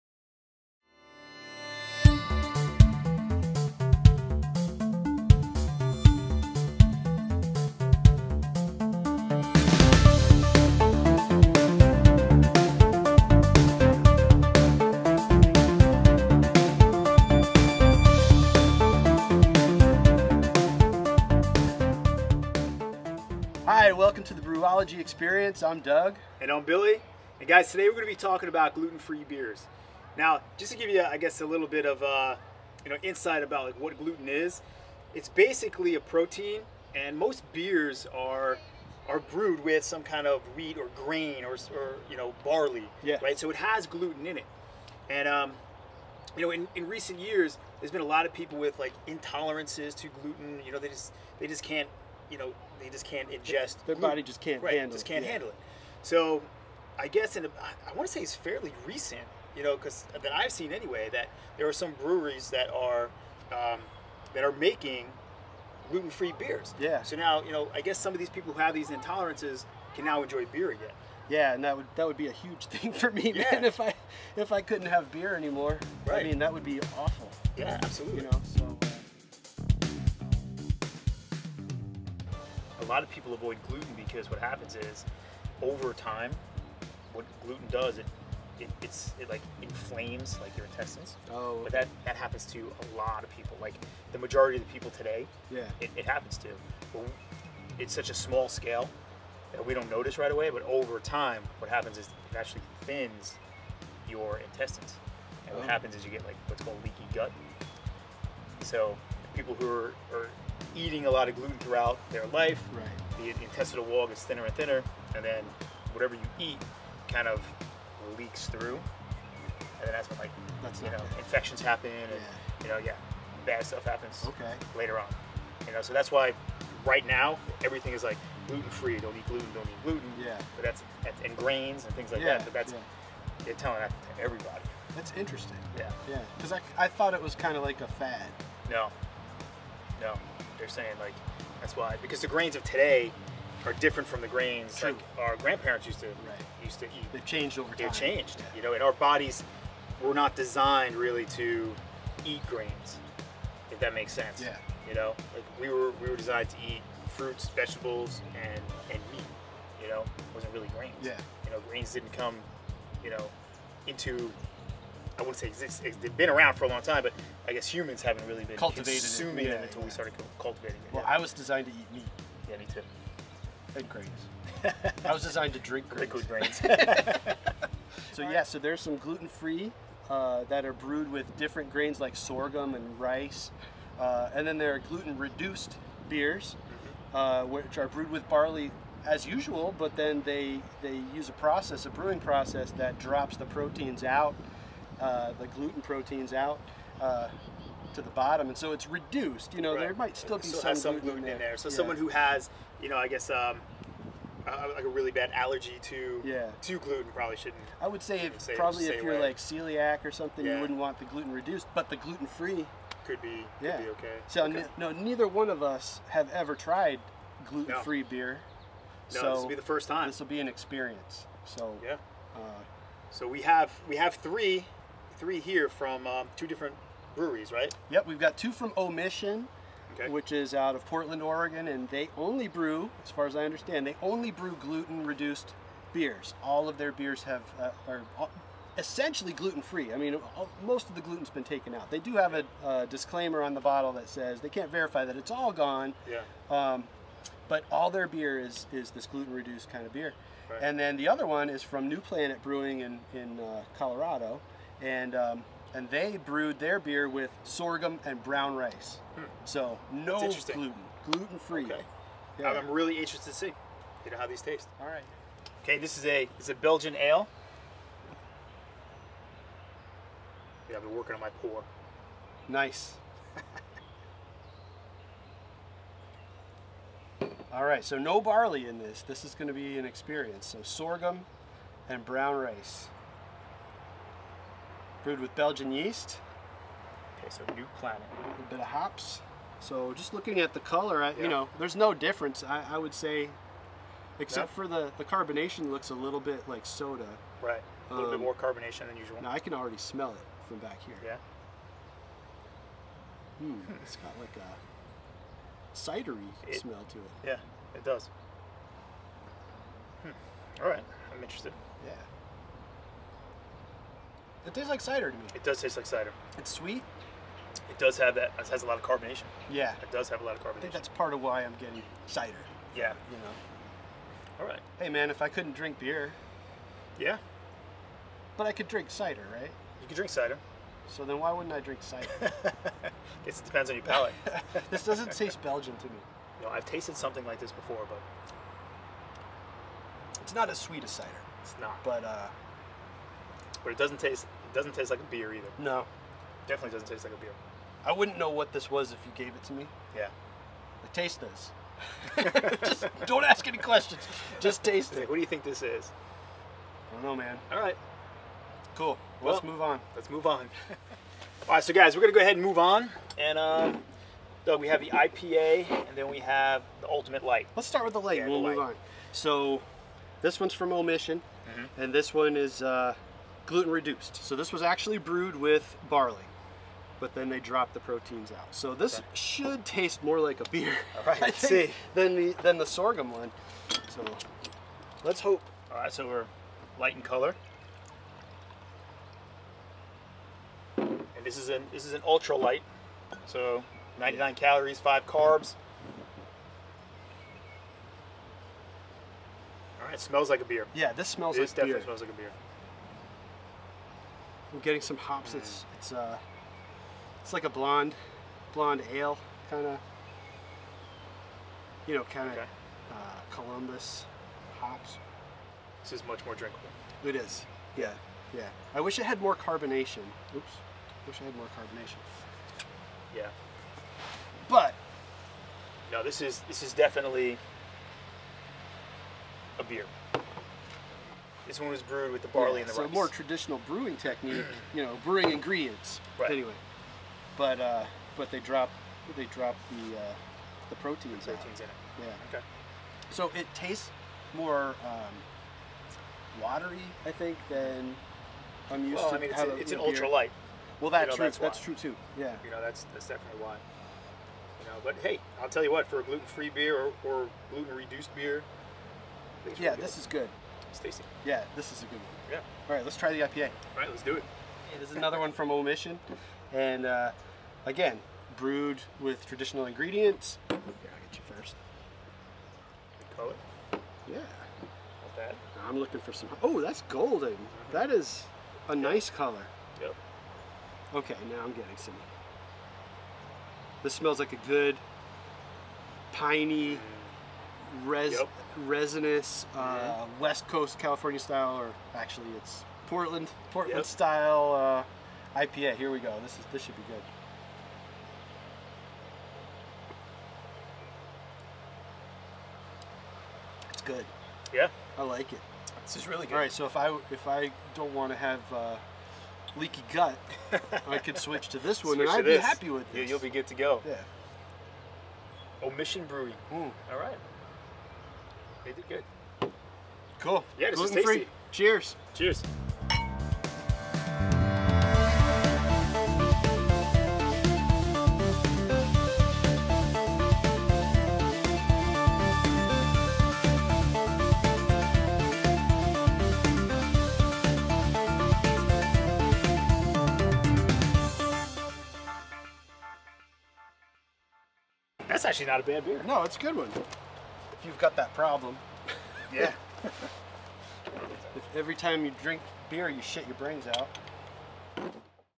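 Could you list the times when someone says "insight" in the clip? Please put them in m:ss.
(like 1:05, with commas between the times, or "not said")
0:33.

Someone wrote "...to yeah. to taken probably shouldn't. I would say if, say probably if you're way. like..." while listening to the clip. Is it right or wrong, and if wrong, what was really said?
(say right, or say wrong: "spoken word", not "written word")
wrong: "gluten", not "taken".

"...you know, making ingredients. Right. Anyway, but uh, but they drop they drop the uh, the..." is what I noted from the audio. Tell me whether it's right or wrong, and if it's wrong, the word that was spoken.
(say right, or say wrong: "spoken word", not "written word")
wrong: "brewing", not "making".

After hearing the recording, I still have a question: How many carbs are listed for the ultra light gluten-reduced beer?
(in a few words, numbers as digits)
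5.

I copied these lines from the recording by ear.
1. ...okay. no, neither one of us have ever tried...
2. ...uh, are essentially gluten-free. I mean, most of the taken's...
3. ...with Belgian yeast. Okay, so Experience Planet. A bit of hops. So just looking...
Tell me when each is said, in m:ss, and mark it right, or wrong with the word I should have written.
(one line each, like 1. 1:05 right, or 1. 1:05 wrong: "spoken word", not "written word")
1. 3:34 right
2. 3:57 wrong: "gluten", not "taken"
3. 4:45 wrong: "New", not "Experience".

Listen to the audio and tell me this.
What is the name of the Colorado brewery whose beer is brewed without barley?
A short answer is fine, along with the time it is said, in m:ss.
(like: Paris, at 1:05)
New Planet Brewing, at 4:11.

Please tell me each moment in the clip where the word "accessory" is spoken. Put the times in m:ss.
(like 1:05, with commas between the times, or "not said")
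not said.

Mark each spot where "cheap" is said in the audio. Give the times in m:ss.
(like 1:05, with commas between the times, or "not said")
not said.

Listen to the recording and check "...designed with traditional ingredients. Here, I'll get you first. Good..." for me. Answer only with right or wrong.
wrong.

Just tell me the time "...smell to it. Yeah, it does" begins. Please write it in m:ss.
5:06.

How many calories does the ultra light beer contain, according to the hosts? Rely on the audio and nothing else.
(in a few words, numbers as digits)
99.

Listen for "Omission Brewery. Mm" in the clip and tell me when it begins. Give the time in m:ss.
8:35.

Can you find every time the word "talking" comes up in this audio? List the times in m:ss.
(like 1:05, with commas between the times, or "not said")
0:28.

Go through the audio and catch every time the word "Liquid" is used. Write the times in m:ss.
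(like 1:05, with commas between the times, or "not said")
2:56.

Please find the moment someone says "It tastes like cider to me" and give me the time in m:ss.
5:14.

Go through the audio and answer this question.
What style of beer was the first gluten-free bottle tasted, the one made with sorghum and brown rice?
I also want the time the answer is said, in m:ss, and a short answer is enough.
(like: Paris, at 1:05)
Belgian ale, at 4:26.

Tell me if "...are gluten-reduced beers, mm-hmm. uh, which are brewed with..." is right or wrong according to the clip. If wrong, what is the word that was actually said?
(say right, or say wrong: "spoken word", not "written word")
right.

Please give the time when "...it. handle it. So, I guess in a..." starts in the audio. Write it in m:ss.
0:55.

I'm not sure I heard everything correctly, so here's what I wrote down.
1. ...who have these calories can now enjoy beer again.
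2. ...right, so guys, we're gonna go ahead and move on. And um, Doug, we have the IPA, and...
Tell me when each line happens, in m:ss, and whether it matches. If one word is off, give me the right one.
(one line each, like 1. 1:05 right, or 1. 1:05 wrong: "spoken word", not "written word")
1. 1:08 wrong: "intolerances", not "calories"
2. 6:01 right.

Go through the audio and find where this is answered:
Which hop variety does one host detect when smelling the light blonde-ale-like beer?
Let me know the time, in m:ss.
6:53.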